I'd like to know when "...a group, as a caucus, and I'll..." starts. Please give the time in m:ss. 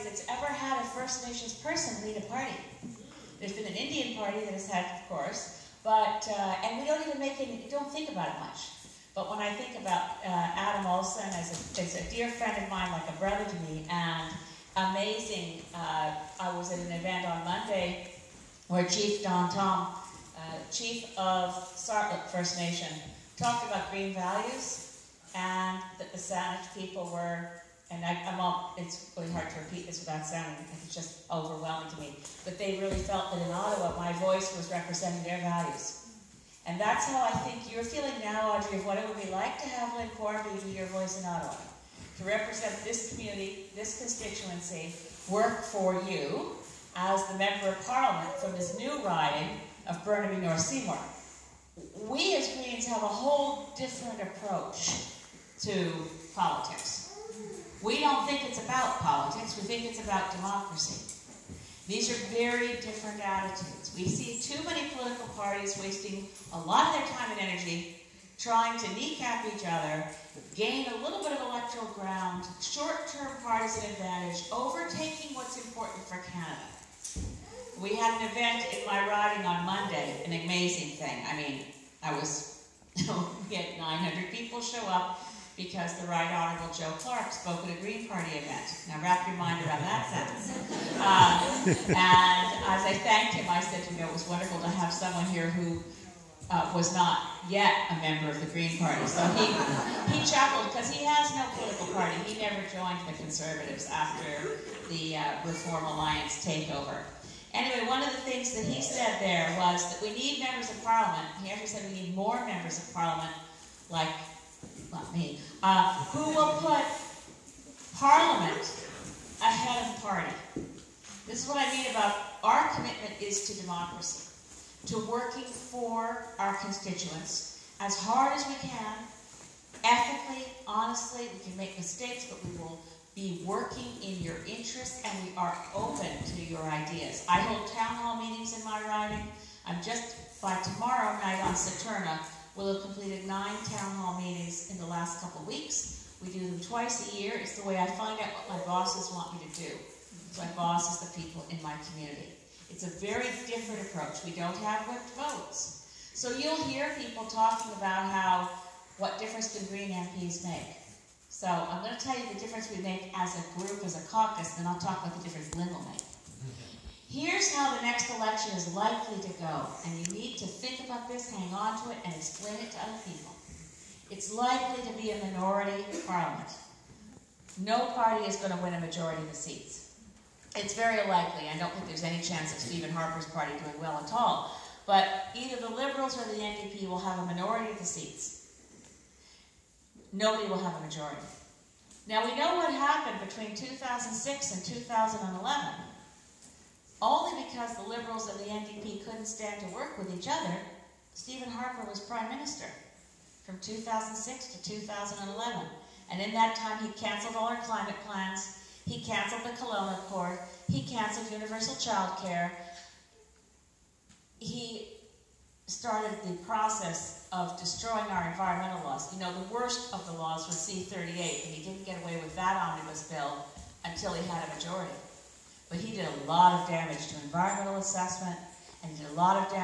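2:43.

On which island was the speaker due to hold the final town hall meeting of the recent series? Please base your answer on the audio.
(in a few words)
Saturna.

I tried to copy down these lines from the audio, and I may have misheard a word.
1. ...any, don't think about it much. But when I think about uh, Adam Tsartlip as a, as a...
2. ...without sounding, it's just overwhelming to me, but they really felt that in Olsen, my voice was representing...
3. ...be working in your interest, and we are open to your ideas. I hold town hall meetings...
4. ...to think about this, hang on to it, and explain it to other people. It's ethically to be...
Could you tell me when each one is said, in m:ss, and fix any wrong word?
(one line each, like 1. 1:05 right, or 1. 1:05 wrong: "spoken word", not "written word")
1. 0:07 wrong: "Olsen", not "Tsartlip"
2. 0:29 wrong: "Ottawa", not "Olsen"
3. 2:13 right
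4. 2:50 wrong: "likely", not "ethically".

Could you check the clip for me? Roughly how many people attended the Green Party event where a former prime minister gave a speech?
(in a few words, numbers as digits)
900.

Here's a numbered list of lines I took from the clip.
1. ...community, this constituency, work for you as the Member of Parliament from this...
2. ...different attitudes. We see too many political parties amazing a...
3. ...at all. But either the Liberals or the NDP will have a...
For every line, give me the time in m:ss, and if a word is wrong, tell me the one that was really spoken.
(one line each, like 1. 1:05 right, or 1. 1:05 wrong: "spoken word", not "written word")
1. 0:43 right
2. 1:02 wrong: "wasting", not "amazing"
3. 3:04 right.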